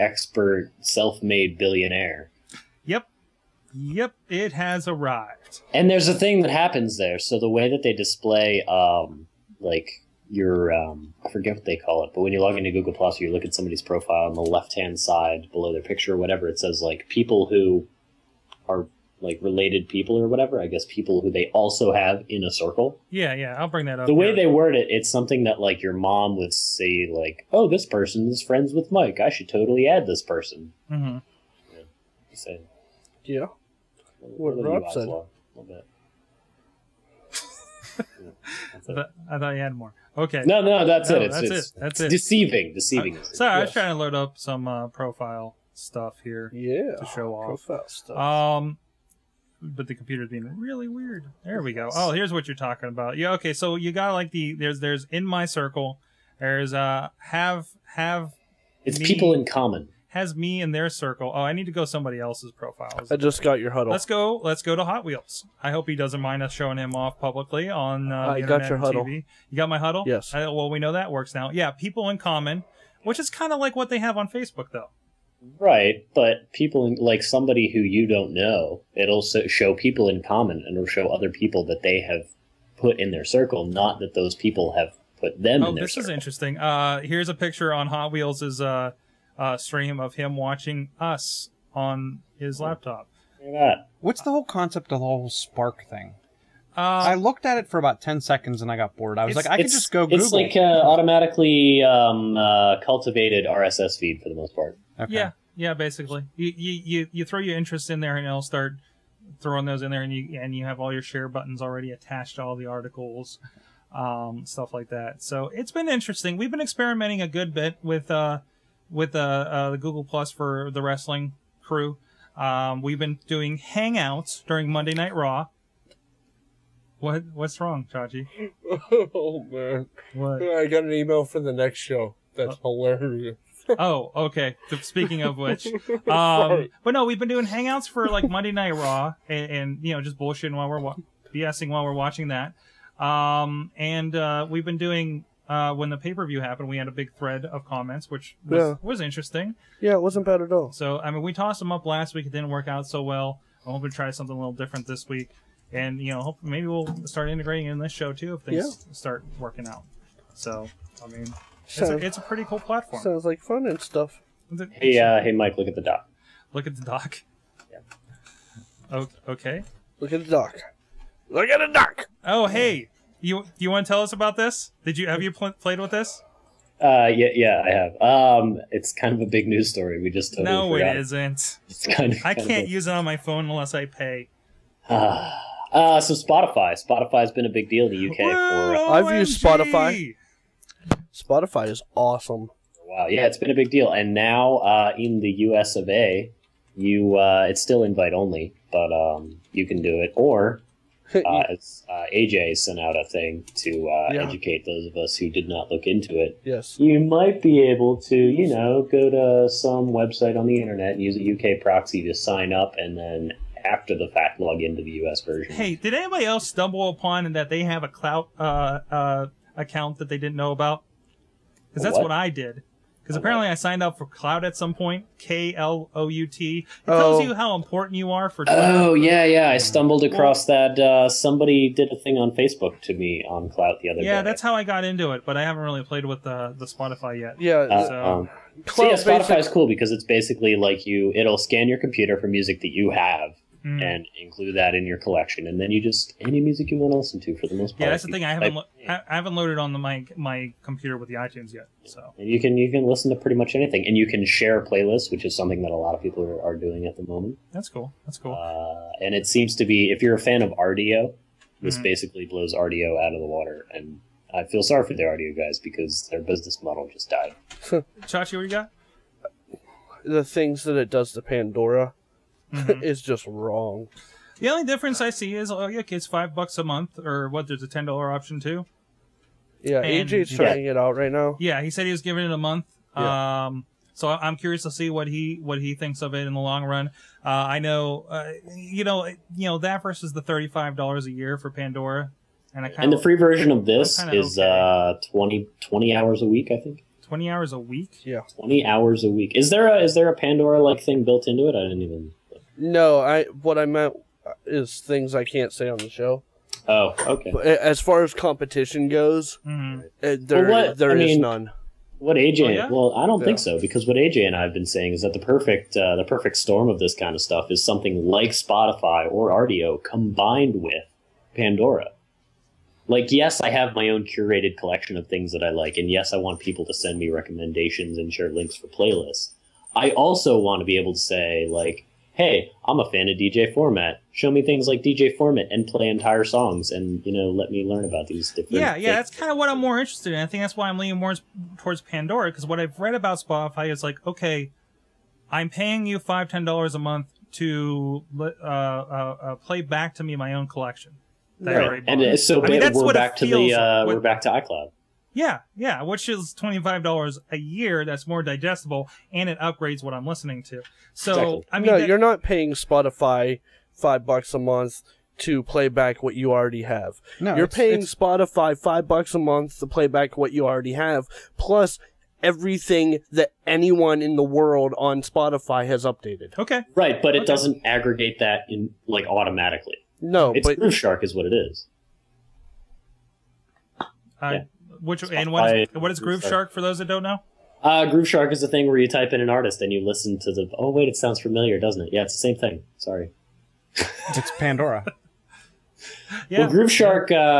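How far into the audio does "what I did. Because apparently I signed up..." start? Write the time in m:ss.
3:42.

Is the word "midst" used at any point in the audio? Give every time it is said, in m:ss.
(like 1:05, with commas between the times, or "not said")
not said.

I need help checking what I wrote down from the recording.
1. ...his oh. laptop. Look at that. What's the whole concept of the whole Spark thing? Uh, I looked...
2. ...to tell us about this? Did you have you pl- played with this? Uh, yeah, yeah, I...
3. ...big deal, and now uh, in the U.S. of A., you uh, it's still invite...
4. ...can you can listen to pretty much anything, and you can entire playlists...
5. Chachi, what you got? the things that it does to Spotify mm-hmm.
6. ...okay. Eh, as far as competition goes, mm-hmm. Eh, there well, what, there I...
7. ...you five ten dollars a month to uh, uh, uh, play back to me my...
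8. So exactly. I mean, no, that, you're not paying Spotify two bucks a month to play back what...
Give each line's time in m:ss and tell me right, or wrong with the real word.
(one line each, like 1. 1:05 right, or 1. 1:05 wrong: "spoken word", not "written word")
1. 1:32 right
2. 2:53 right
3. 3:13 right
4. 4:12 wrong: "share", not "entire"
5. 4:27 wrong: "Pandora", not "Spotify"
6. 5:07 right
7. 5:45 right
8. 6:00 wrong: "five", not "two".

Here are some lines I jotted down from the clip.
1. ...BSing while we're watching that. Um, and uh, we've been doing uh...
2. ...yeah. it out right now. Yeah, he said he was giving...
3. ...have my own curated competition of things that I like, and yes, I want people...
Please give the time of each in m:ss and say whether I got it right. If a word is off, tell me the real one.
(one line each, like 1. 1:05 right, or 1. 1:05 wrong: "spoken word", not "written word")
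1. 2:21 right
2. 4:40 right
3. 5:23 wrong: "collection", not "competition".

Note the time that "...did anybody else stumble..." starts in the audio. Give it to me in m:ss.
3:35.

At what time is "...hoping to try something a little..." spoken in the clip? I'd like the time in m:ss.
2:33.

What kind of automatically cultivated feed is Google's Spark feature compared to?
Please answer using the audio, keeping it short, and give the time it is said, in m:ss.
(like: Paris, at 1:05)
RSS feed, at 1:43.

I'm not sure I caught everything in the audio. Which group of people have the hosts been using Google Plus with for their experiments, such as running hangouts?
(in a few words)
The wrestling crew.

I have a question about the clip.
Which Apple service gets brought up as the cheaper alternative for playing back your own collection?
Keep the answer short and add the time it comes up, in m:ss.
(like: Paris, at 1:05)
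iCloud, at 5:54.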